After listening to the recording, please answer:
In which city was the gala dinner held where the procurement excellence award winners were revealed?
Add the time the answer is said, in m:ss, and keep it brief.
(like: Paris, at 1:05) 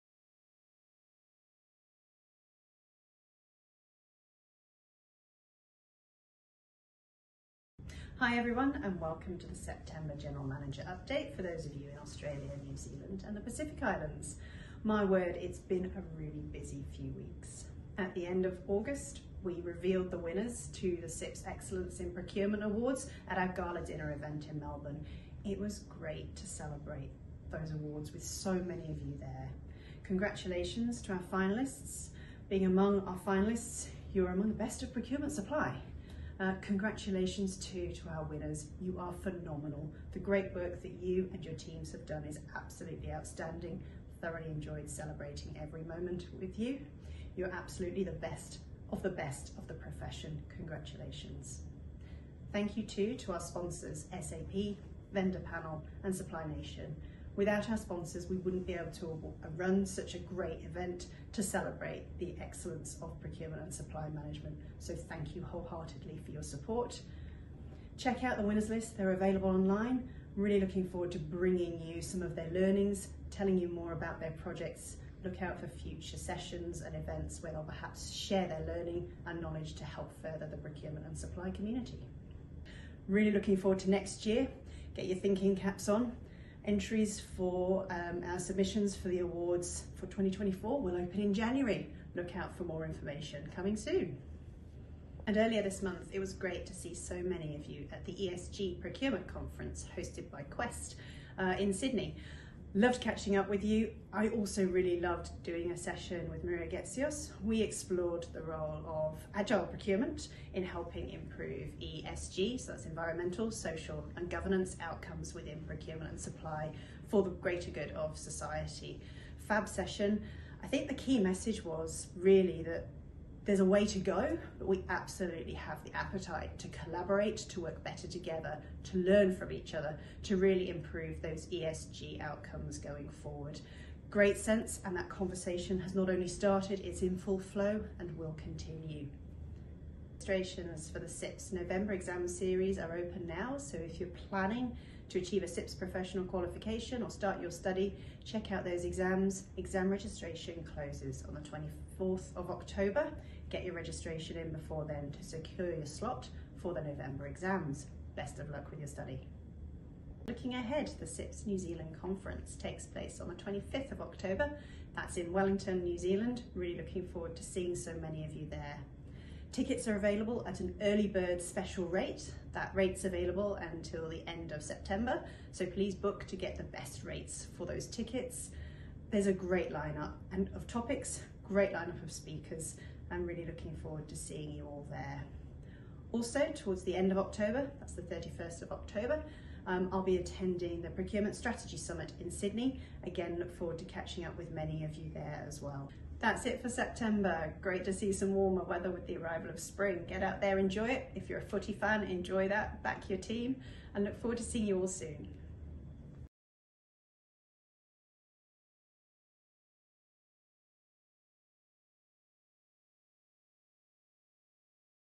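Melbourne, at 0:24.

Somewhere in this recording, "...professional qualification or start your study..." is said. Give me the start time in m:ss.
2:25.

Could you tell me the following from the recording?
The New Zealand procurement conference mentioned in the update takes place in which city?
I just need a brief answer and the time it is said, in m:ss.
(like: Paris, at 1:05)
Wellington, at 2:45.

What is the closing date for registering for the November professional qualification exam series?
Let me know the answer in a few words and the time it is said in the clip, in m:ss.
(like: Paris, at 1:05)
24 October, at 2:31.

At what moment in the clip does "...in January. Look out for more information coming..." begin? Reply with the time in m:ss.
1:31.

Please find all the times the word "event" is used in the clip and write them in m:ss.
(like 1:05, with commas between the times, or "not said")
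0:24, 1:00, 1:16.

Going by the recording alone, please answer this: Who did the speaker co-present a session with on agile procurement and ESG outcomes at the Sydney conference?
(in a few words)
Maria Getzios.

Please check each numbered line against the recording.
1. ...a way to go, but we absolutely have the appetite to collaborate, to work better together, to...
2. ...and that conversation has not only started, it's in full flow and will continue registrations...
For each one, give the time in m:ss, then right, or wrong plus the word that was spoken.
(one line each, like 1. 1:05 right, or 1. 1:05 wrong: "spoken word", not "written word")
1. 2:03 right
2. 2:14 right.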